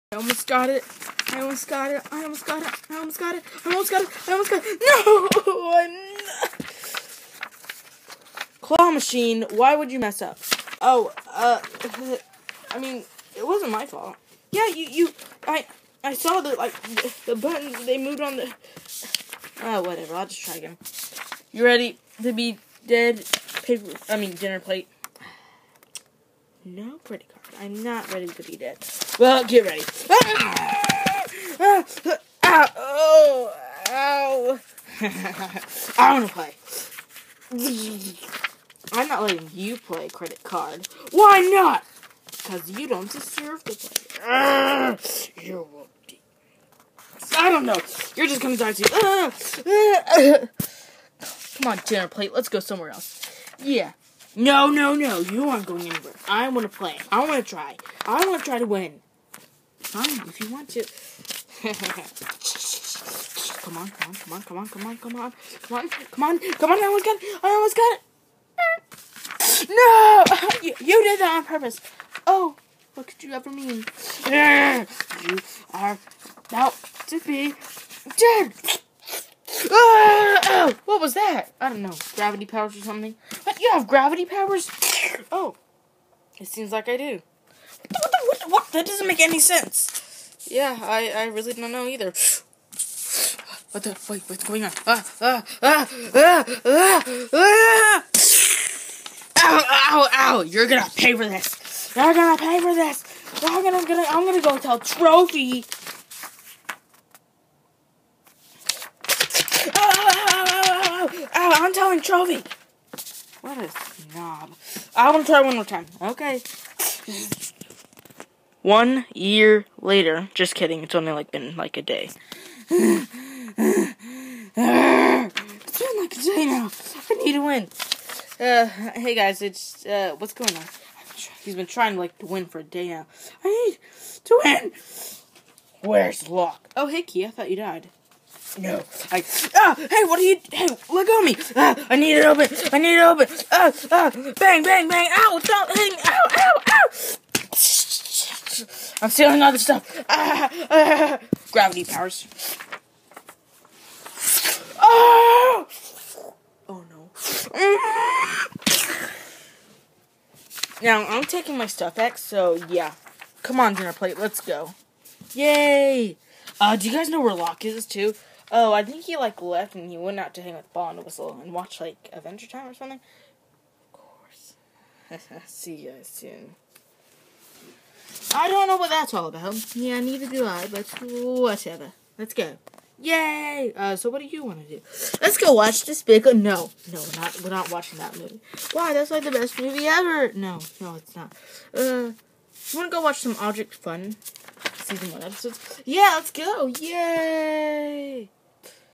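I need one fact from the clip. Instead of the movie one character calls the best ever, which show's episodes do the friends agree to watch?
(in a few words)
Object Fun.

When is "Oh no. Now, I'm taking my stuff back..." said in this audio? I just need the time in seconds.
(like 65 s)
156 s.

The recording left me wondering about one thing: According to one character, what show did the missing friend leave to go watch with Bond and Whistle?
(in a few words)
Adventure Time.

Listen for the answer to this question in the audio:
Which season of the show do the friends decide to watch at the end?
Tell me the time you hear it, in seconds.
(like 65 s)
194 s.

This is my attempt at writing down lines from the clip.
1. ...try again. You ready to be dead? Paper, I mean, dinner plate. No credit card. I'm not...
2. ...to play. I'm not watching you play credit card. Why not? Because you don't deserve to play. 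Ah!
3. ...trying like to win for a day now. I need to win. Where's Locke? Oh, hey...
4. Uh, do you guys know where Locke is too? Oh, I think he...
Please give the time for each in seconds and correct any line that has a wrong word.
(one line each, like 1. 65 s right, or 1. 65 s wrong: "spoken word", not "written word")
1. 20 s right
2. 36 s wrong: "letting", not "watching"
3. 131 s right
4. 166 s right.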